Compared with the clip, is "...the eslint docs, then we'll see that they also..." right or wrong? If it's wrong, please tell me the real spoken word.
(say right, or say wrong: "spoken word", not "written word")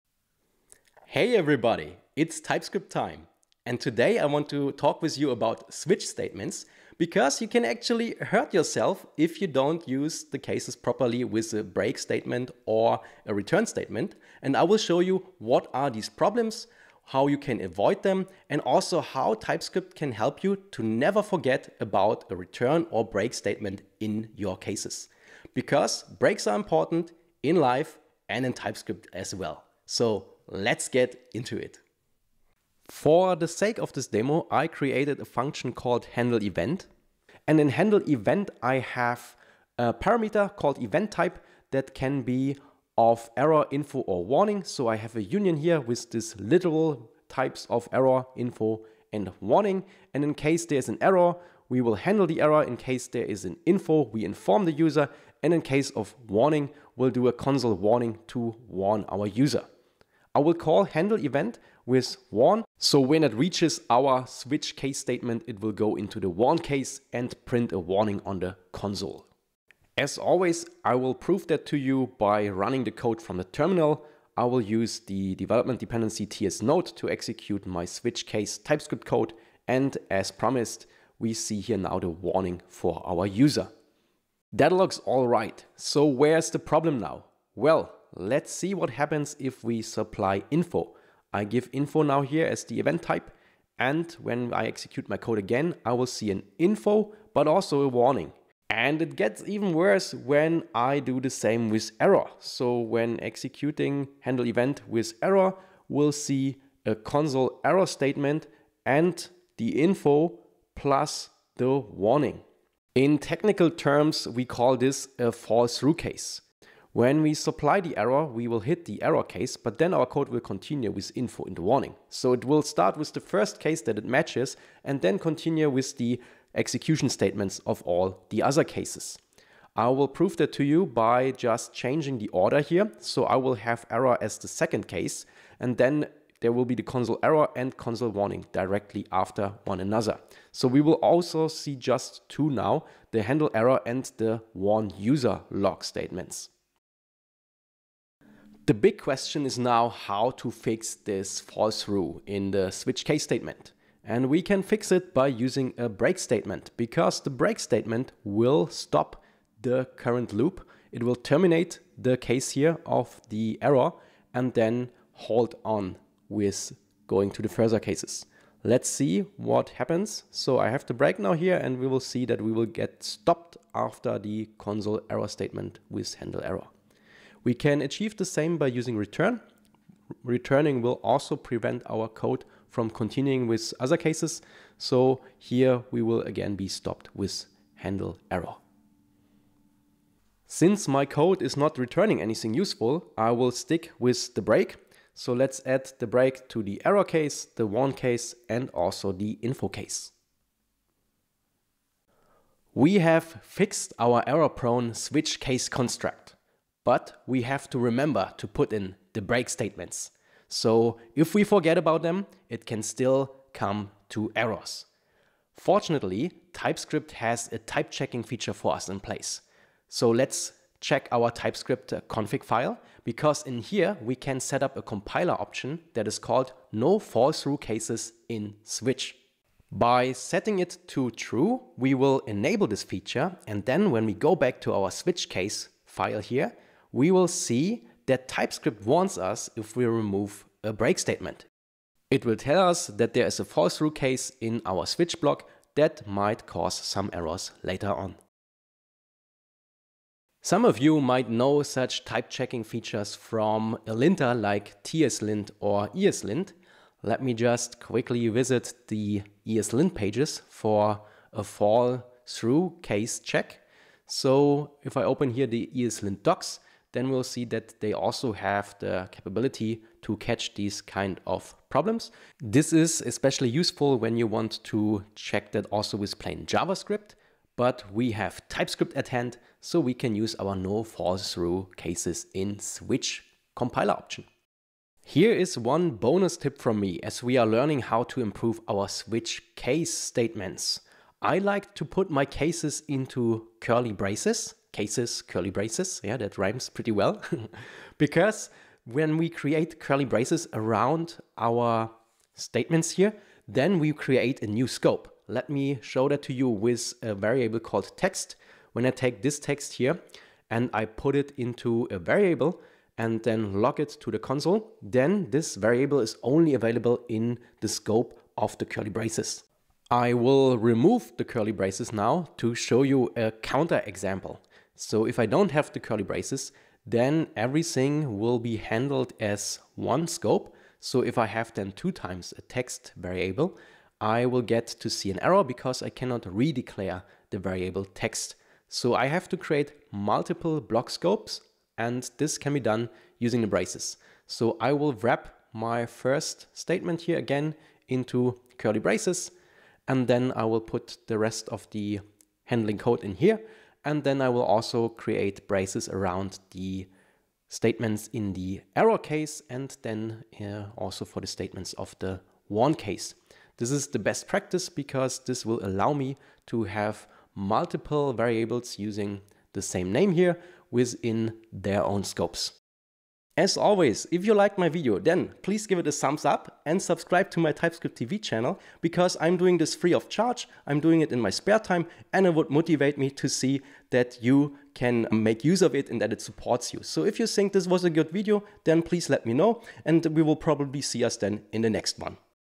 right.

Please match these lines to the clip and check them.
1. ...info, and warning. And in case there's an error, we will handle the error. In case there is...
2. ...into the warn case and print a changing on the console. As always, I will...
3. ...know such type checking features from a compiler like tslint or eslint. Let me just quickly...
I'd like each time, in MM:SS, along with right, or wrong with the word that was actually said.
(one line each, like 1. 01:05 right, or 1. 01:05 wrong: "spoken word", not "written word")
1. 00:48 right
2. 01:05 wrong: "warning", not "changing"
3. 04:11 wrong: "linter", not "compiler".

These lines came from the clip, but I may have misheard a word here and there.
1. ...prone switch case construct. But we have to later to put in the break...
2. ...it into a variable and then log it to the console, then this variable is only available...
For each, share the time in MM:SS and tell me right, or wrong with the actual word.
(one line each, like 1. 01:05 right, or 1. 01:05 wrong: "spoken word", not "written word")
1. 03:24 wrong: "remember", not "later"
2. 05:11 right.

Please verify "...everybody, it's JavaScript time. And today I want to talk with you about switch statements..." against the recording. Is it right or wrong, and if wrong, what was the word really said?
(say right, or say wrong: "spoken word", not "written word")
wrong: "TypeScript", not "JavaScript".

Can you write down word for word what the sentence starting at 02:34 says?
And we can fix it by using a break statement because the break statement will stop the current loop.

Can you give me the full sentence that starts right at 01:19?
And as promised, we see here now the warning for our user.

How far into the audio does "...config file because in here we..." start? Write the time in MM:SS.
03:42.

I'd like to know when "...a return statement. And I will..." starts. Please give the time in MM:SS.
00:13.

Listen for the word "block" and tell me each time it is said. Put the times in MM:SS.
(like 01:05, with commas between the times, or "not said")
04:05, 05:40.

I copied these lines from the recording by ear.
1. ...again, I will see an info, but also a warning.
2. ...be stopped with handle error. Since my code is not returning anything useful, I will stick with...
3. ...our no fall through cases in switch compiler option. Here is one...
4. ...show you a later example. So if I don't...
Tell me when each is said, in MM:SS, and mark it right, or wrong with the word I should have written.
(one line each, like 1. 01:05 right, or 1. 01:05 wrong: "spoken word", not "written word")
1. 01:35 right
2. 03:06 right
3. 04:40 right
4. 05:22 wrong: "counter", not "later".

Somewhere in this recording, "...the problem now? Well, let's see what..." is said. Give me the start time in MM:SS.
01:26.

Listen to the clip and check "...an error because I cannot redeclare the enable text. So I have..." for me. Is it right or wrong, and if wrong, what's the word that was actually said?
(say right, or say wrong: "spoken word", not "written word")
wrong: "variable", not "enable".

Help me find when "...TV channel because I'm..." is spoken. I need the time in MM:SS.
06:17.